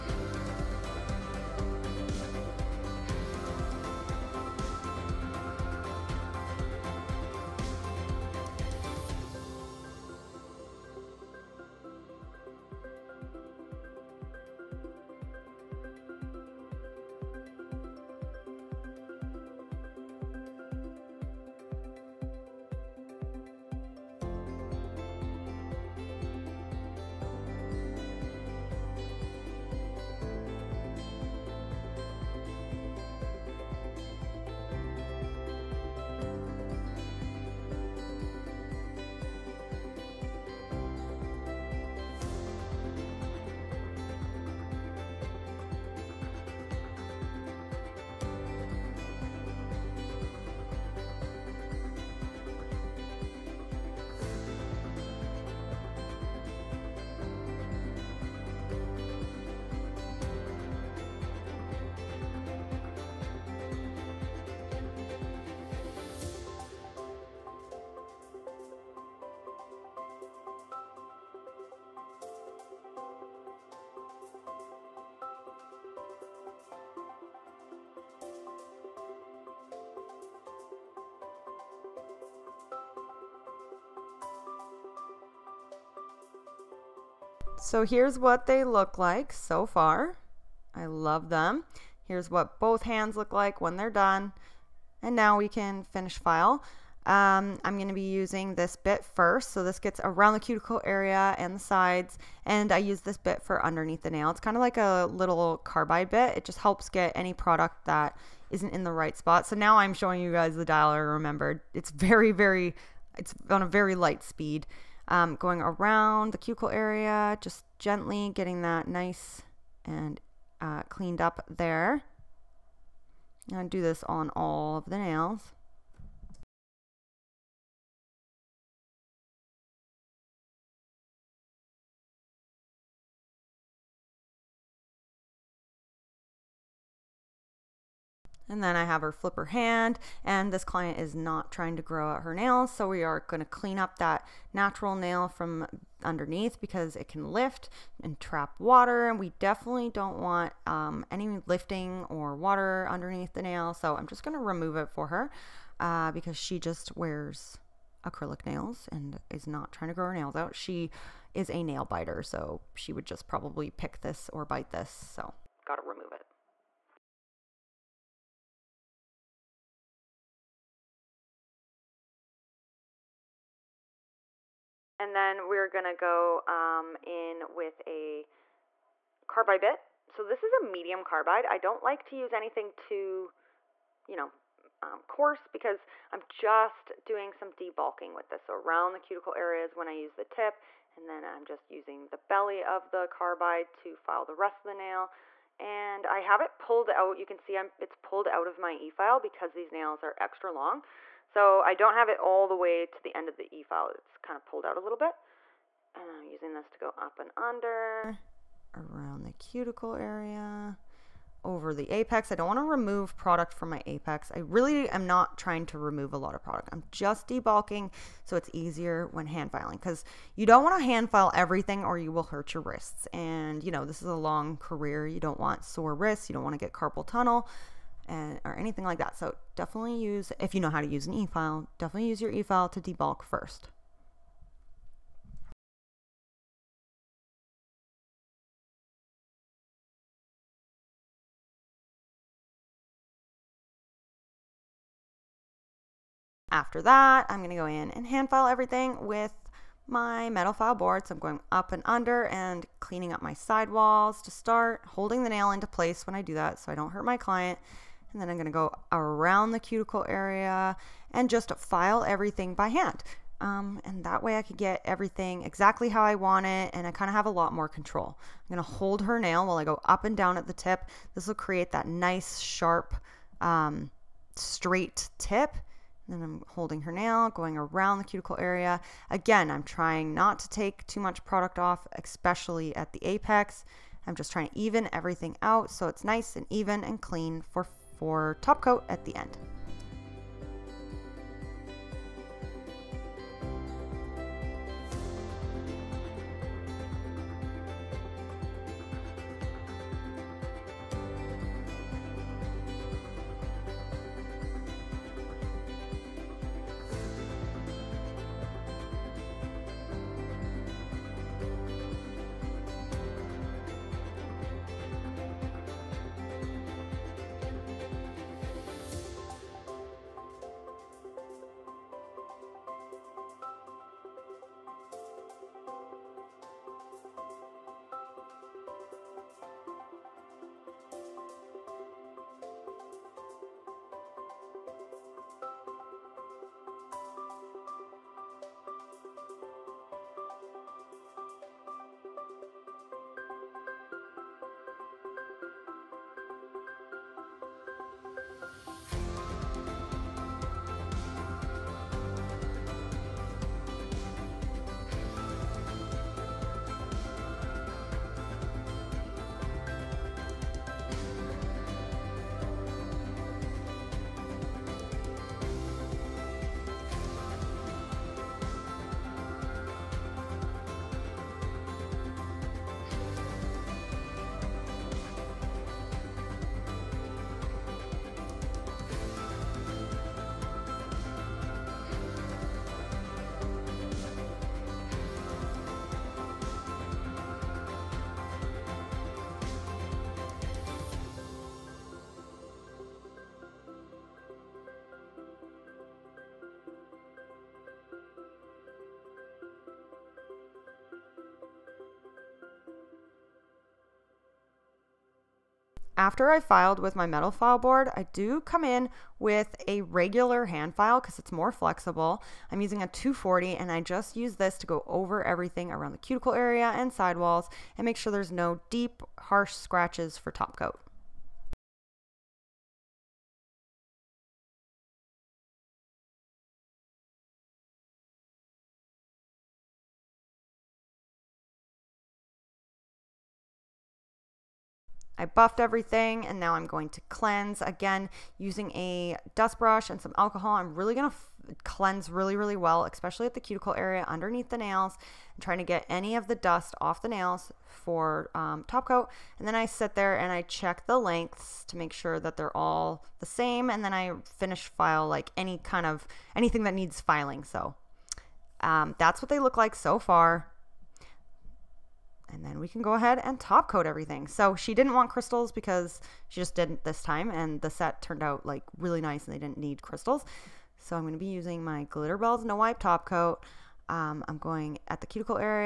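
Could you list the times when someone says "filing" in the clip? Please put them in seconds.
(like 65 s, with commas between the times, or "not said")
219 s, 457 s.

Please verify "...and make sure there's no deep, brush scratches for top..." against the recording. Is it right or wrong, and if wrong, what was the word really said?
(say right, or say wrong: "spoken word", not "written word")
wrong: "harsh", not "brush".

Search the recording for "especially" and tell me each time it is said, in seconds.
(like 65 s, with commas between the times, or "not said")
282 s, 442 s.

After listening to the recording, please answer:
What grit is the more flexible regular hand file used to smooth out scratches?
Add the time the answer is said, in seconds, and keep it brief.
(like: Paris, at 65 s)
240, at 412 s.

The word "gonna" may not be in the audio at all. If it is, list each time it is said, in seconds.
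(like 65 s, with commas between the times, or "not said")
247 s.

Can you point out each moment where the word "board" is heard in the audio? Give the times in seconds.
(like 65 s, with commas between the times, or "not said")
250 s, 407 s.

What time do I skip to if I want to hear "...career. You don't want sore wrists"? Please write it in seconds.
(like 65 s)
224 s.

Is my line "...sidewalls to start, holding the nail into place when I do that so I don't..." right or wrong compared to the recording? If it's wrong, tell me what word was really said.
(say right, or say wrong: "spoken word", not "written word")
wrong: "walls", not "sidewalls".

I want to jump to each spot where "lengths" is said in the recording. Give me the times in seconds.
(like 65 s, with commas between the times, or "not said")
450 s.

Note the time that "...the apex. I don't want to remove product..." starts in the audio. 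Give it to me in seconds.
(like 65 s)
211 s.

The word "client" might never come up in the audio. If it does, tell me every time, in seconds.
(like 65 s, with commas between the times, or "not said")
140 s, 257 s.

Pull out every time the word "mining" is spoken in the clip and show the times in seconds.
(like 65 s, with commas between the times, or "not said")
not said.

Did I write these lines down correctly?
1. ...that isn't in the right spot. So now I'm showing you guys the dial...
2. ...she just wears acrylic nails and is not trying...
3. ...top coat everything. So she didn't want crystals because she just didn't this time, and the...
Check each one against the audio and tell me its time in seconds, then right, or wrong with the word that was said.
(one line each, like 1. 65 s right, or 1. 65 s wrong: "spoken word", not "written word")
1. 107 s right
2. 156 s right
3. 463 s right.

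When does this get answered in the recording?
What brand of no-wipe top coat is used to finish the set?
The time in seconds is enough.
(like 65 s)
471 s.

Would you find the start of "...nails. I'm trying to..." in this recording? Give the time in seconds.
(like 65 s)
444 s.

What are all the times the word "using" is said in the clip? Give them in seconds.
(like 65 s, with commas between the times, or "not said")
98 s, 191 s, 206 s, 412 s, 438 s, 471 s.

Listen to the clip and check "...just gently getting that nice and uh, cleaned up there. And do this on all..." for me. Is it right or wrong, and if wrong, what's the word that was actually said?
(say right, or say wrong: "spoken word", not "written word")
right.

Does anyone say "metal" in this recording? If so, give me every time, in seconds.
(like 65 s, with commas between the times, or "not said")
250 s, 407 s.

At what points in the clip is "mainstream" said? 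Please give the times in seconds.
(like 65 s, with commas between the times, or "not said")
not said.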